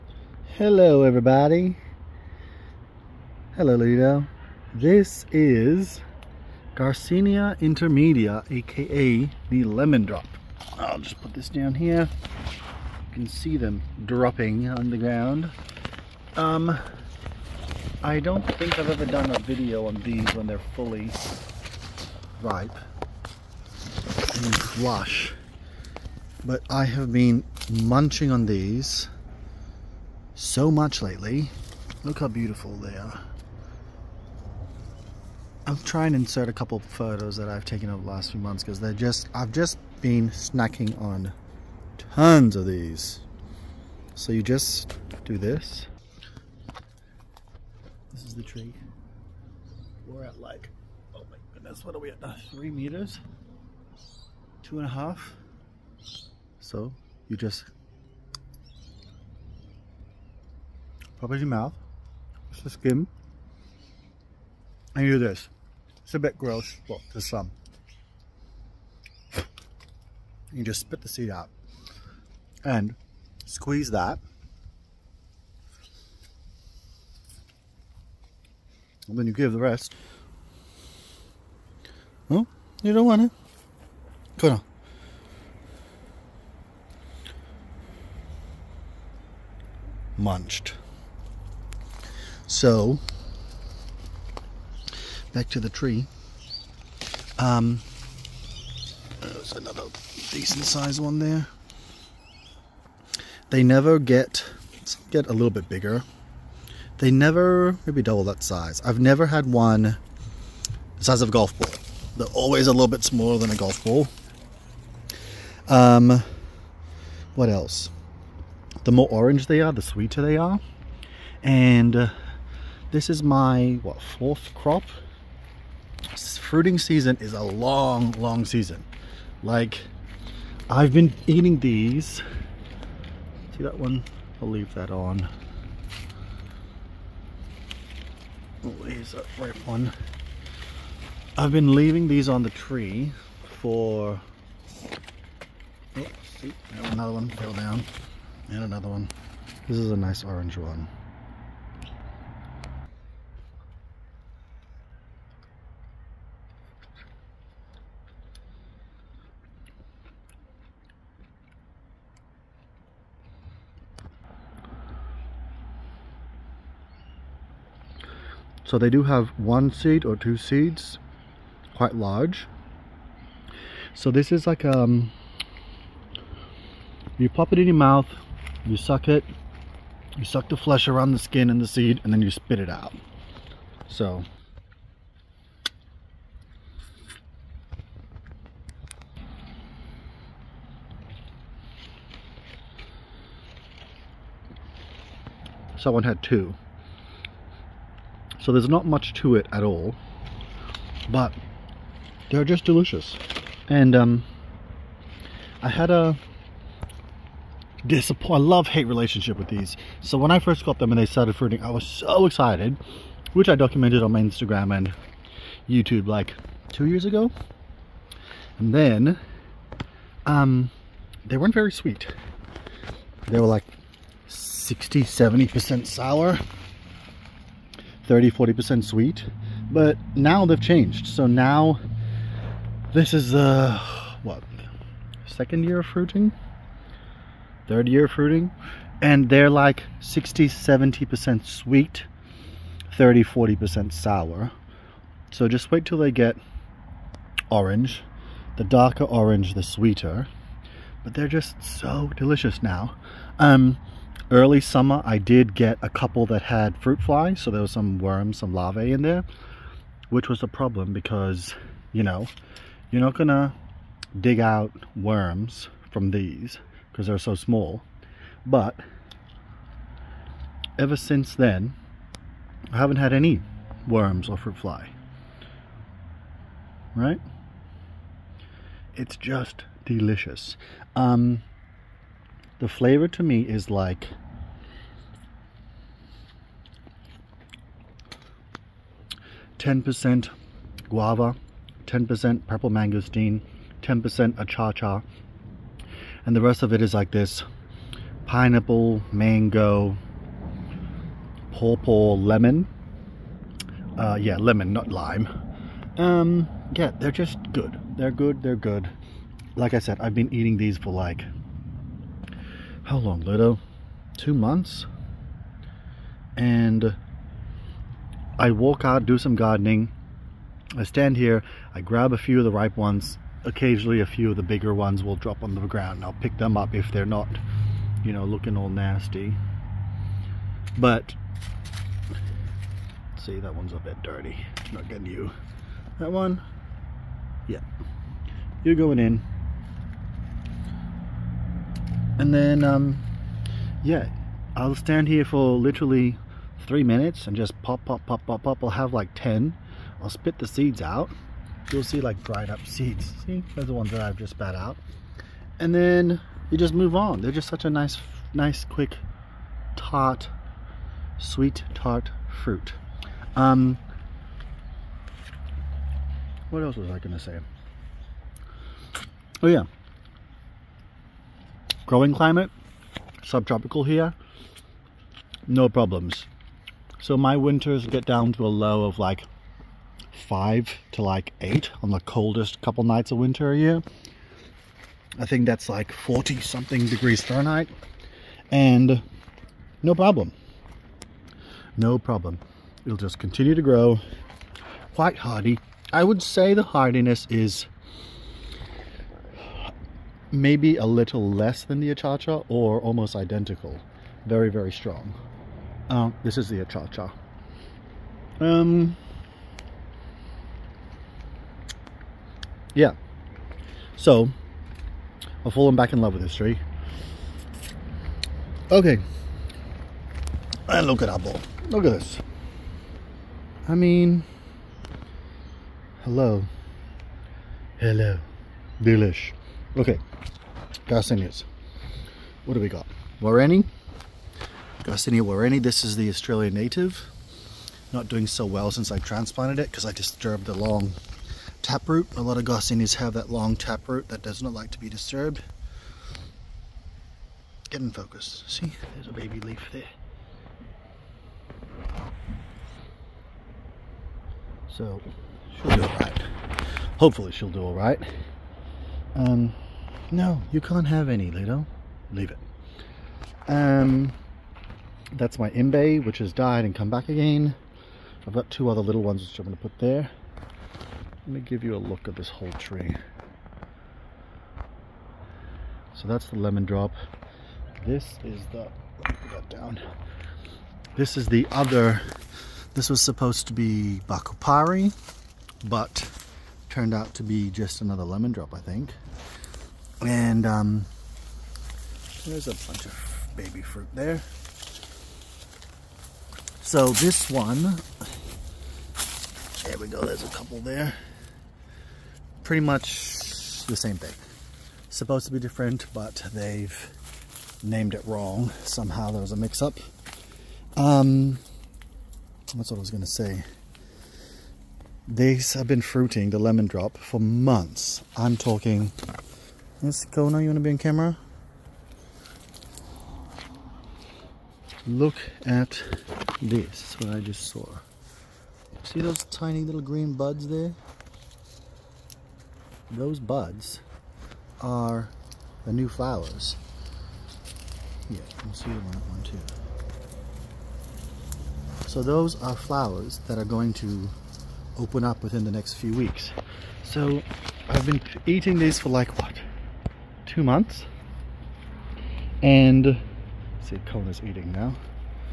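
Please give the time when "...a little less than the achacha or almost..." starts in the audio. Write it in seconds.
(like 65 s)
400 s.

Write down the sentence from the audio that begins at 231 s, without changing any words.
So now this is the, what, second year of fruiting?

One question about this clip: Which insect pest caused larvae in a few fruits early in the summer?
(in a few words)
fruit flies.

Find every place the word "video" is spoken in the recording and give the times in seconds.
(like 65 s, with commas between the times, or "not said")
19 s.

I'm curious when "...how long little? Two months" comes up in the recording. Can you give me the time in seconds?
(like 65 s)
312 s.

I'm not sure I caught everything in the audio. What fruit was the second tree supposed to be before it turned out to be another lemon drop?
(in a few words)
Bakupari.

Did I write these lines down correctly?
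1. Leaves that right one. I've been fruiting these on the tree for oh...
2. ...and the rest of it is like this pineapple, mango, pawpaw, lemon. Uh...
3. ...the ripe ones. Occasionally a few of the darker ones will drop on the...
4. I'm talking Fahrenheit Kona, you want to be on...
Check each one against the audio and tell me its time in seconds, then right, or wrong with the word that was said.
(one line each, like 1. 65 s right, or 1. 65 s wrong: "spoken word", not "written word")
1. 138 s wrong: "leaving", not "fruiting"
2. 296 s right
3. 322 s wrong: "bigger", not "darker"
4. 518 s wrong: "Miss", not "Fahrenheit".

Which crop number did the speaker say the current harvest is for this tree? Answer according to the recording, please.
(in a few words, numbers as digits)
fourth.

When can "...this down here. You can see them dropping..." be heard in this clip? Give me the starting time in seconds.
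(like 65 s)
11 s.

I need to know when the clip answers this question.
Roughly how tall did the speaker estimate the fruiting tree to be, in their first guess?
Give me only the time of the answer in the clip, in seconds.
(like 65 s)
52 s.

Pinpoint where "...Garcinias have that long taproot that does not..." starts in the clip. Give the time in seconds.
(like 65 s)
442 s.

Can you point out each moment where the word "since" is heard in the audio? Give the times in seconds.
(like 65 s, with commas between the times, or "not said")
270 s, 438 s.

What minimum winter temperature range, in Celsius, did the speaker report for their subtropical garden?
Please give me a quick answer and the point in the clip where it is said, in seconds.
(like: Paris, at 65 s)
5 to 8, at 380 s.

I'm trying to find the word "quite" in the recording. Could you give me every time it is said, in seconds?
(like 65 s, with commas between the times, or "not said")
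171 s, 394 s.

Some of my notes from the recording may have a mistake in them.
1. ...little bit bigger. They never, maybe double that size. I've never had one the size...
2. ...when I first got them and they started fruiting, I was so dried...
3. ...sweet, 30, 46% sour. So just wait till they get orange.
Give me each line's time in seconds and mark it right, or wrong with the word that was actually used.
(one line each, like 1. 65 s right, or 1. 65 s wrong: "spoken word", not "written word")
1. 105 s right
2. 210 s wrong: "excited", not "dried"
3. 241 s wrong: "40", not "46".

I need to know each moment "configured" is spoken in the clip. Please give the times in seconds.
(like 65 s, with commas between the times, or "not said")
not said.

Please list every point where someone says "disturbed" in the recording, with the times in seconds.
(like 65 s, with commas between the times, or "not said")
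439 s, 444 s.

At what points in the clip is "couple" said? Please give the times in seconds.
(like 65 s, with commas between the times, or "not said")
36 s, 255 s, 382 s, 500 s.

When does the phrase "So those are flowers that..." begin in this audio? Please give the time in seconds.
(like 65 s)
541 s.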